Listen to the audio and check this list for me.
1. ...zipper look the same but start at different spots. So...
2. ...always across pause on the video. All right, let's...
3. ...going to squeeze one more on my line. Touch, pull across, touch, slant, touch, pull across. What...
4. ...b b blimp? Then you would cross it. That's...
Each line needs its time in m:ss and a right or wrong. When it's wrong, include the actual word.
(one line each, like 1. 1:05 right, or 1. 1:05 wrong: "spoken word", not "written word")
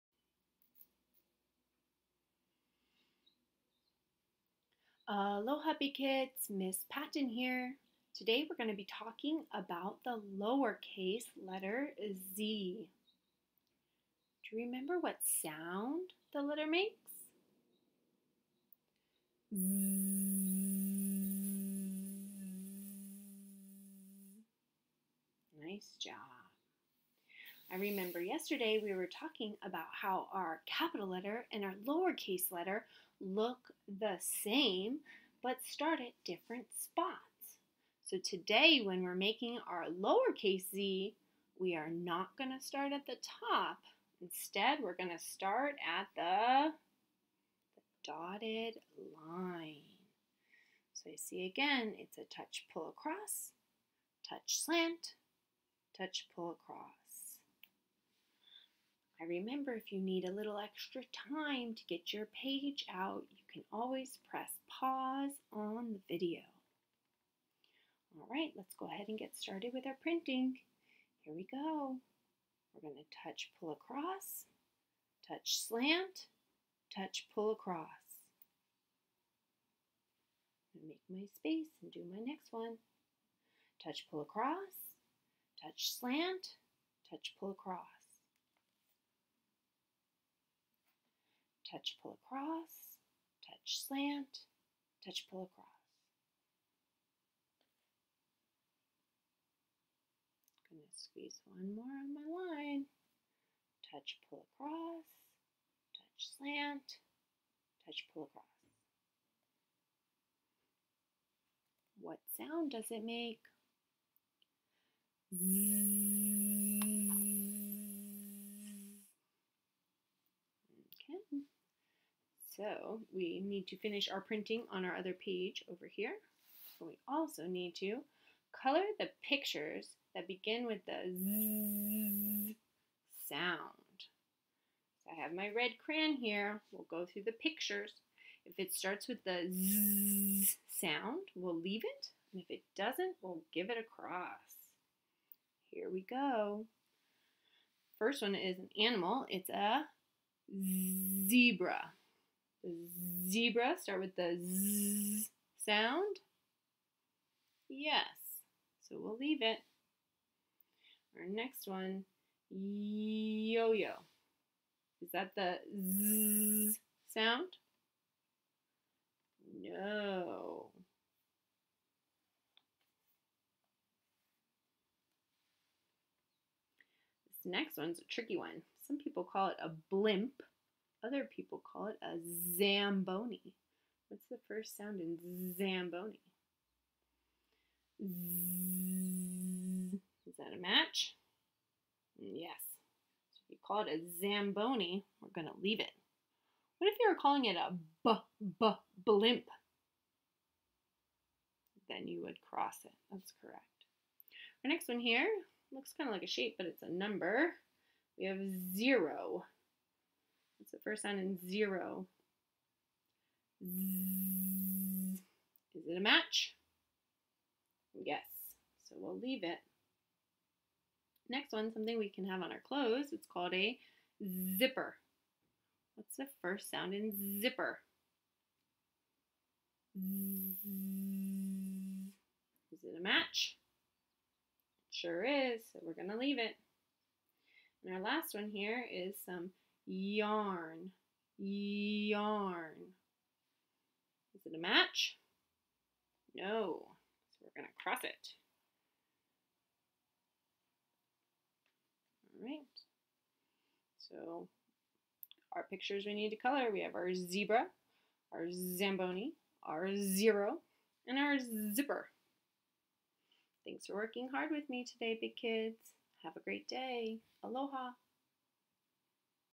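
1. 0:32 wrong: "letter", not "zipper"
2. 1:03 wrong: "press", not "across"
3. 1:40 right
4. 3:18 right.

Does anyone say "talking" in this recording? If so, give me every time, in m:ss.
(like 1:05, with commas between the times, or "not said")
0:08, 0:29.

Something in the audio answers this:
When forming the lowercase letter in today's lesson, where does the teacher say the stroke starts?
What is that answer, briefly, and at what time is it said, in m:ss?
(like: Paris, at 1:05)
The dotted line, at 0:47.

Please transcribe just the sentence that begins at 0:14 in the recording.
Do you remember what sound the letter makes?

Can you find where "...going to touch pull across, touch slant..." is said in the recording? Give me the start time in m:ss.
1:12.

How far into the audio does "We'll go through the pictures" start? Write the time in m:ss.
2:16.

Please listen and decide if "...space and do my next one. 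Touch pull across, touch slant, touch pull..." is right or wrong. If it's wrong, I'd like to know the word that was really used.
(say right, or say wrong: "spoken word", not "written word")
right.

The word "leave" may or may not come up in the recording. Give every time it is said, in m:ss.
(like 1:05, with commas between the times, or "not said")
2:21, 2:39, 3:15, 3:39, 3:56.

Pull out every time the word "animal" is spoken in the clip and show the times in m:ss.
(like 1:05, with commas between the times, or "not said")
2:28.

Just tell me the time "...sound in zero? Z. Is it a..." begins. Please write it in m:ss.
3:31.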